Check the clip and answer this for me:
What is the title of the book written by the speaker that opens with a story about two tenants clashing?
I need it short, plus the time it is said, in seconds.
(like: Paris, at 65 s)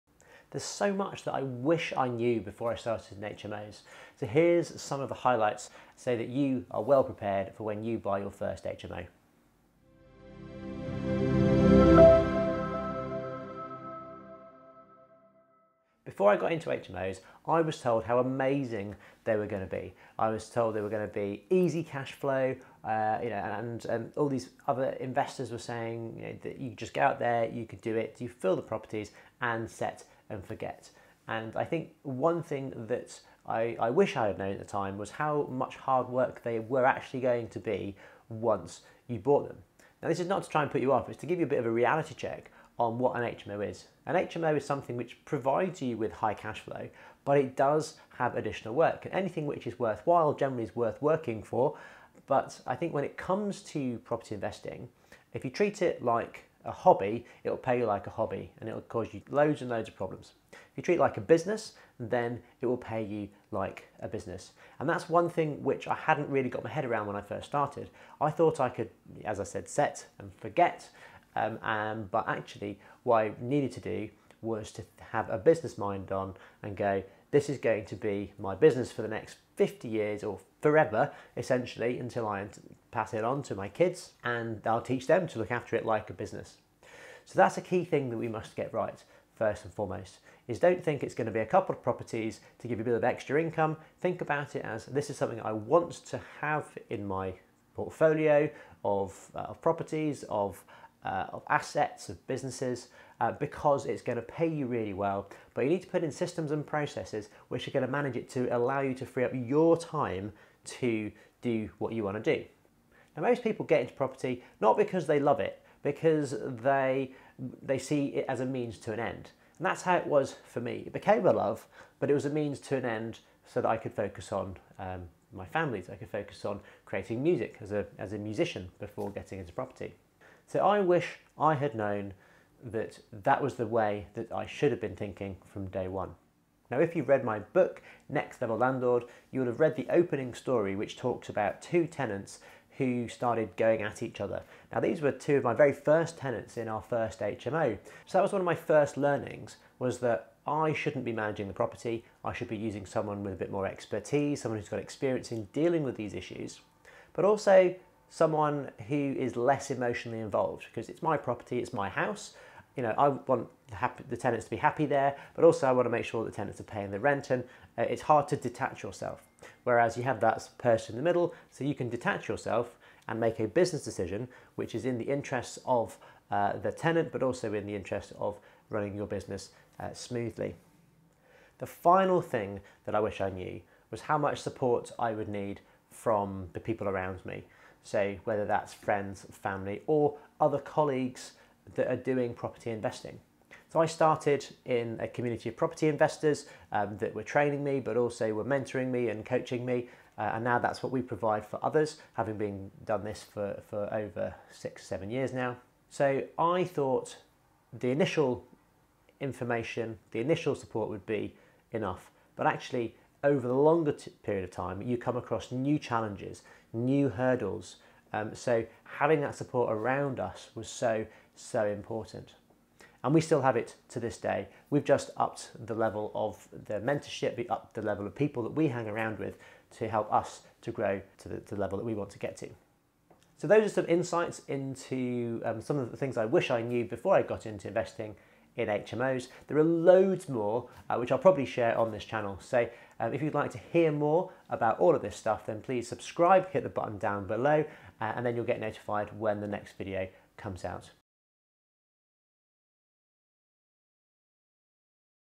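Next Level Landlord, at 138 s.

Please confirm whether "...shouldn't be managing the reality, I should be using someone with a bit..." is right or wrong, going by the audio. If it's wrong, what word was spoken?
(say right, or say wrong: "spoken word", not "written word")
wrong: "property", not "reality".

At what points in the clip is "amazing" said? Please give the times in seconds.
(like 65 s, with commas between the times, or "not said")
18 s.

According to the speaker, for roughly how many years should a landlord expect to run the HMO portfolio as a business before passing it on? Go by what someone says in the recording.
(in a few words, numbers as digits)
50 years.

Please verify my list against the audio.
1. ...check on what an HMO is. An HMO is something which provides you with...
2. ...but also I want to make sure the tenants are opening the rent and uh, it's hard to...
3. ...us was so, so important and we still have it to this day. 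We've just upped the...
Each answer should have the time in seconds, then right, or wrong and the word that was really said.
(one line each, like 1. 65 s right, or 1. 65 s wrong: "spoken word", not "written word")
1. 42 s right
2. 165 s wrong: "paying", not "opening"
3. 220 s right.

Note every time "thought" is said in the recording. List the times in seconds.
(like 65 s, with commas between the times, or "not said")
68 s, 206 s.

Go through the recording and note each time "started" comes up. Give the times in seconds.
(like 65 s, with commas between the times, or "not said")
2 s, 67 s, 143 s, 193 s.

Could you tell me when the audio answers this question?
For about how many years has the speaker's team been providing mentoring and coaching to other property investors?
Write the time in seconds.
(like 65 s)
204 s.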